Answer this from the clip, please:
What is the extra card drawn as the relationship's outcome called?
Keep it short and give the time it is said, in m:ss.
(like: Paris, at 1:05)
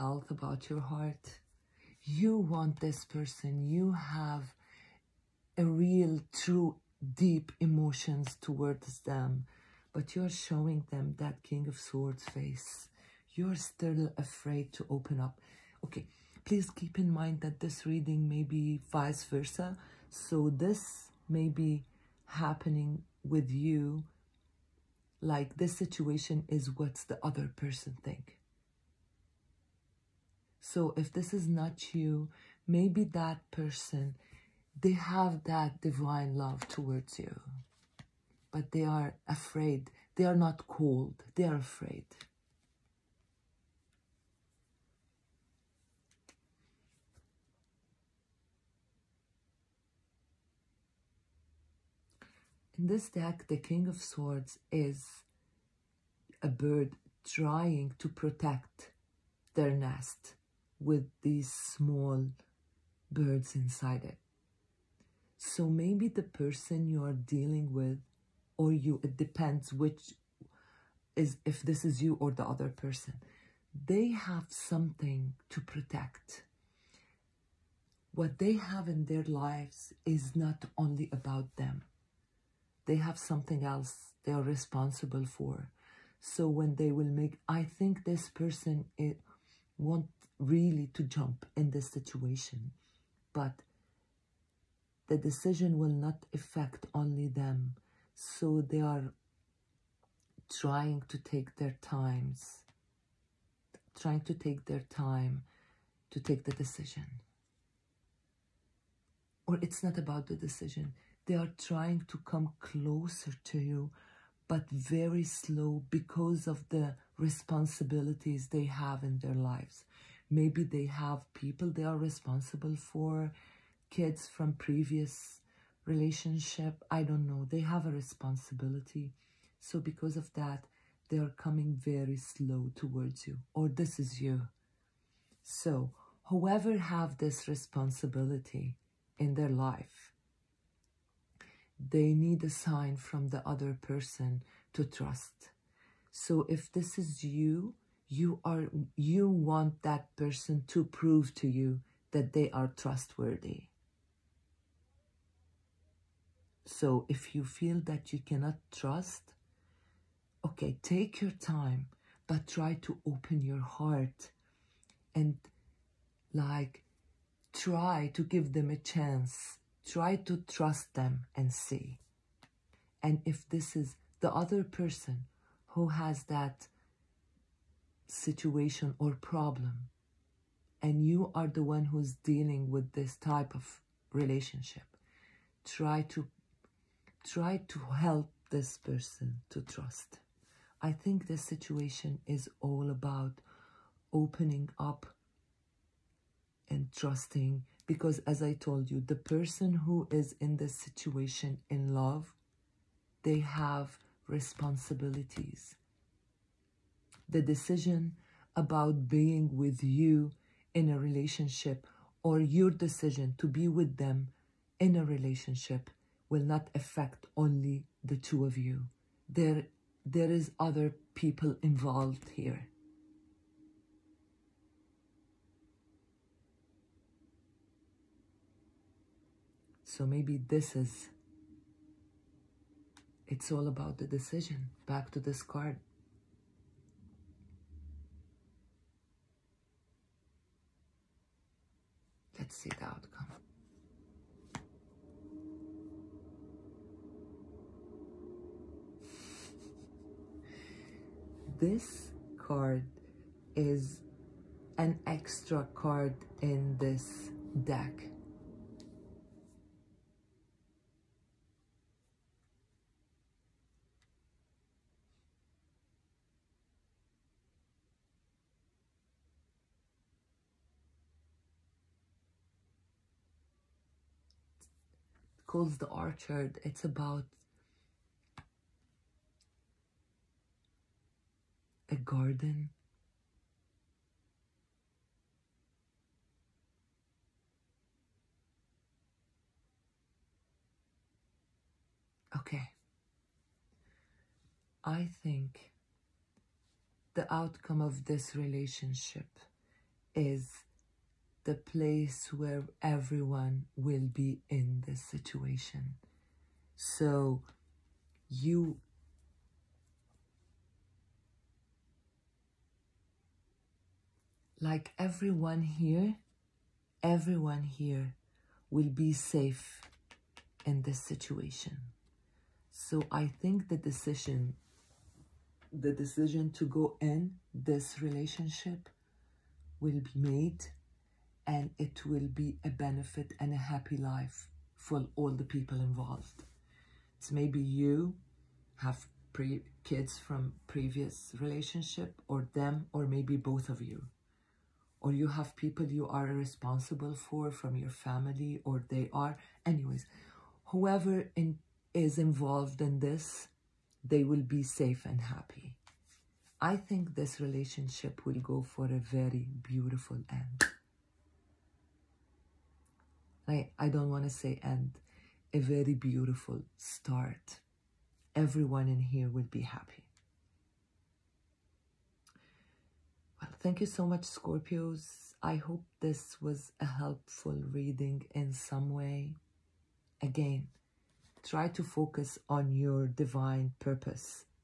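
The Orchard, at 4:35.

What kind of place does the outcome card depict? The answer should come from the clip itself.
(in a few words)
A garden.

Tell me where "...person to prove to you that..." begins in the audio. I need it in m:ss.
2:30.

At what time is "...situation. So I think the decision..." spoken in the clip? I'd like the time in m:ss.
5:21.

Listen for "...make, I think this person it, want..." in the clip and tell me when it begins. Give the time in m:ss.
1:27.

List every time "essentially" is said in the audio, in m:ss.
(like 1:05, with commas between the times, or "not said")
not said.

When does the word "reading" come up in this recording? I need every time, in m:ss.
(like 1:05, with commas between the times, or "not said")
0:17, 6:17.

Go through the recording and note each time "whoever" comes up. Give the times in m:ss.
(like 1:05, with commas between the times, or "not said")
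2:16, 5:50.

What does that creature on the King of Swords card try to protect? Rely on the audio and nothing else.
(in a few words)
Their nest.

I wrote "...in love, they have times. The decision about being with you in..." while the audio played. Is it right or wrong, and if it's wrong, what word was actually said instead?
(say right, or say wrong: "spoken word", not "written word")
wrong: "responsibilities", not "times".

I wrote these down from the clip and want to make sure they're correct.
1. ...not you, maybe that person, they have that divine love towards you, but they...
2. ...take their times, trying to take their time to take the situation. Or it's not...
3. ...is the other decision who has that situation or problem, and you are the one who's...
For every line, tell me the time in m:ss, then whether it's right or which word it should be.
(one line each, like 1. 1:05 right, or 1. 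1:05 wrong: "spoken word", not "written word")
1. 0:31 right
2. 1:41 wrong: "decision", not "situation"
3. 2:53 wrong: "person", not "decision".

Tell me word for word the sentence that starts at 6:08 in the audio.
Everyone in here will be happy.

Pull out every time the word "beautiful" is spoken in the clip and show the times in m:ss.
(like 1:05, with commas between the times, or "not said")
5:59, 6:05.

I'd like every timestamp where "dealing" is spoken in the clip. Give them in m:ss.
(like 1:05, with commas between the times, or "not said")
1:07, 3:02.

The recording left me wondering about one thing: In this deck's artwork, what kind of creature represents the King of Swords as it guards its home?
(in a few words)
A bird.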